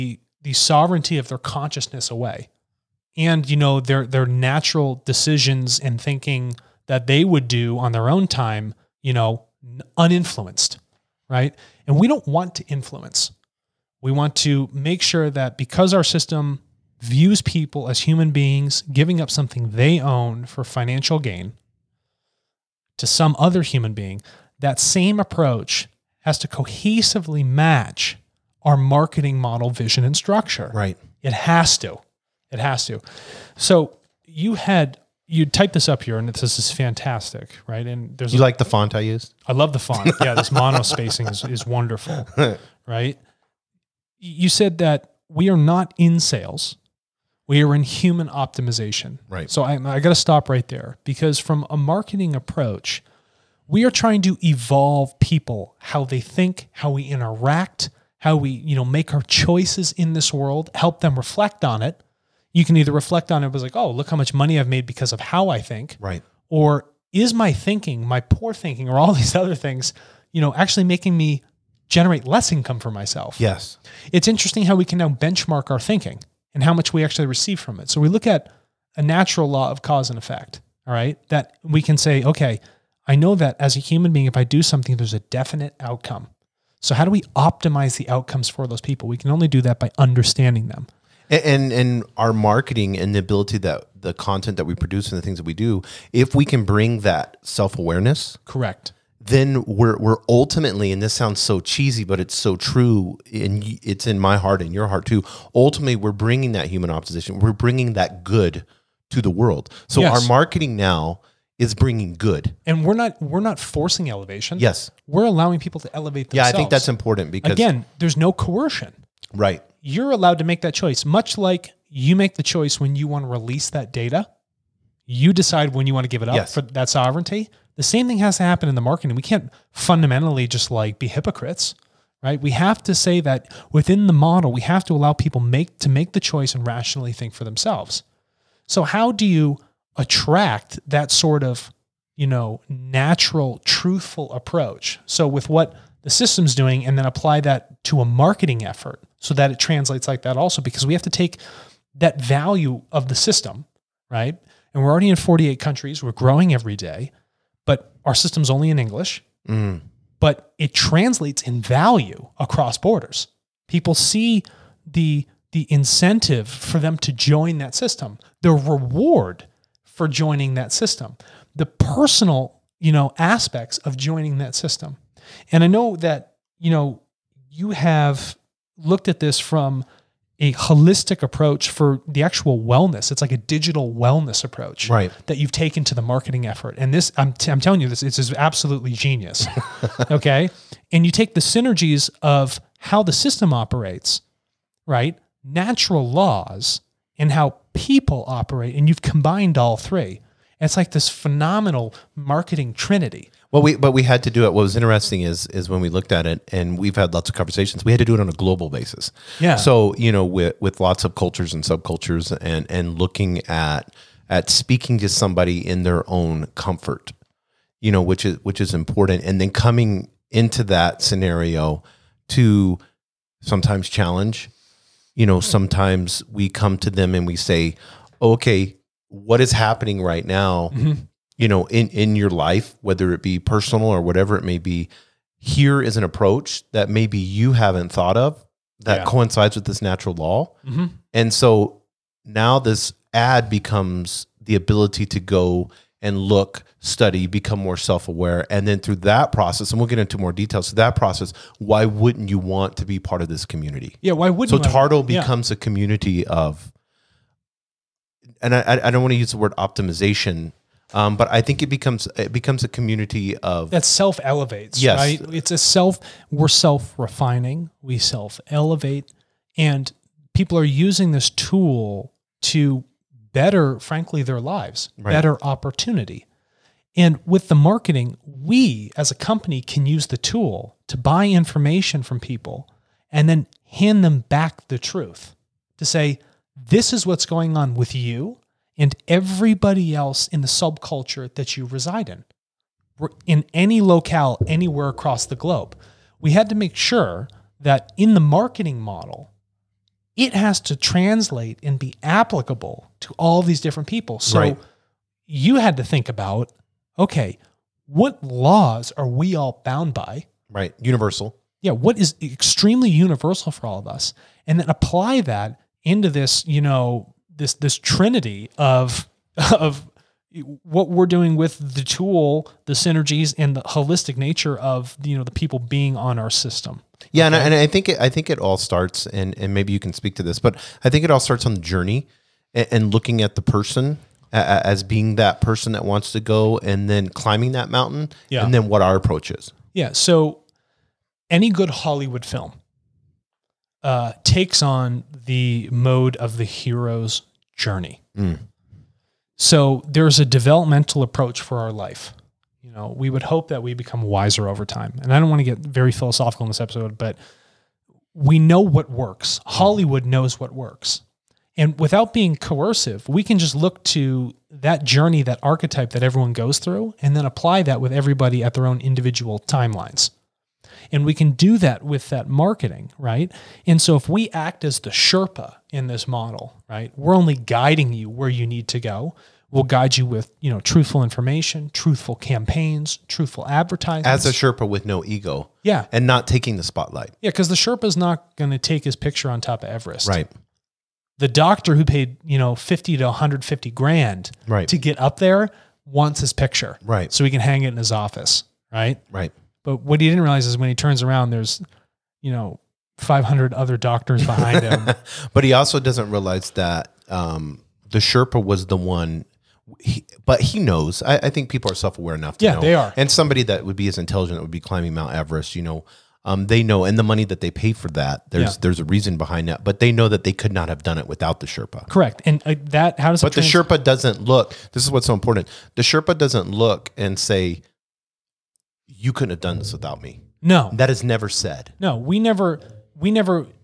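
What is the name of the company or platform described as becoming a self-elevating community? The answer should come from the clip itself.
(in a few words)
Tartle.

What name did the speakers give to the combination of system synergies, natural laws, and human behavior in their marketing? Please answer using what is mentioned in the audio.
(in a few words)
Marketing trinity.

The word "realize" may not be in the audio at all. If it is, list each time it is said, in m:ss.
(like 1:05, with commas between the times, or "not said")
6:40, 6:46.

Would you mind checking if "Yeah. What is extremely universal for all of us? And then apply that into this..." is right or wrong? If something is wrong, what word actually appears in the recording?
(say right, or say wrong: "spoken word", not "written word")
right.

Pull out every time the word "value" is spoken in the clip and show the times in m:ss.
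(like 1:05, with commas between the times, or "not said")
2:32, 2:41.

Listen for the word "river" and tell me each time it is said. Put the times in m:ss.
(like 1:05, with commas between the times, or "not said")
not said.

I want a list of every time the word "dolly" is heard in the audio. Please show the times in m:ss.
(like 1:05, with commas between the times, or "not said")
not said.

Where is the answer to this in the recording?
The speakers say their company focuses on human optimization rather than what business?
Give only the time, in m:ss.
0:45.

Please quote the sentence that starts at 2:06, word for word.
for that sovereignty the same thing has to happen in the marketing.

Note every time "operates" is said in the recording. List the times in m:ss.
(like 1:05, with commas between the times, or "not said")
3:13, 3:18.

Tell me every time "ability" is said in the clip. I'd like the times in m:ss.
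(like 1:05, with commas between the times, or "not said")
1:33, 4:04.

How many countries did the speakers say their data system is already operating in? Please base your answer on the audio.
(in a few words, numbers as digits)
48.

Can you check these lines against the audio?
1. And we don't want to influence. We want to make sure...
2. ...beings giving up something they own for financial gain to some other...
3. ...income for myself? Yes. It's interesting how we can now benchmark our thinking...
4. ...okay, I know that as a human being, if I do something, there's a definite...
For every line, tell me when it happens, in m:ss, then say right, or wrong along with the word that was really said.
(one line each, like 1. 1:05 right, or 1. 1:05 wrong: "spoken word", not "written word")
1. 0:11 right
2. 0:18 right
3. 1:12 right
4. 1:22 right.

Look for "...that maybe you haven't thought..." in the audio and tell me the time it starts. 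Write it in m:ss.
3:56.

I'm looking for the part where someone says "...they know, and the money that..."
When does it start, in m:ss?
6:56.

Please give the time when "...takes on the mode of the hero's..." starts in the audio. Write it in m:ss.
5:44.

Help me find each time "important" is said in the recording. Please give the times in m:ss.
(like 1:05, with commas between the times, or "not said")
1:56, 3:38, 7:05.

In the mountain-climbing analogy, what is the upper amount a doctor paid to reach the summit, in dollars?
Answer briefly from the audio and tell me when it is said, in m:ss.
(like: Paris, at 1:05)
$150,000, at 6:33.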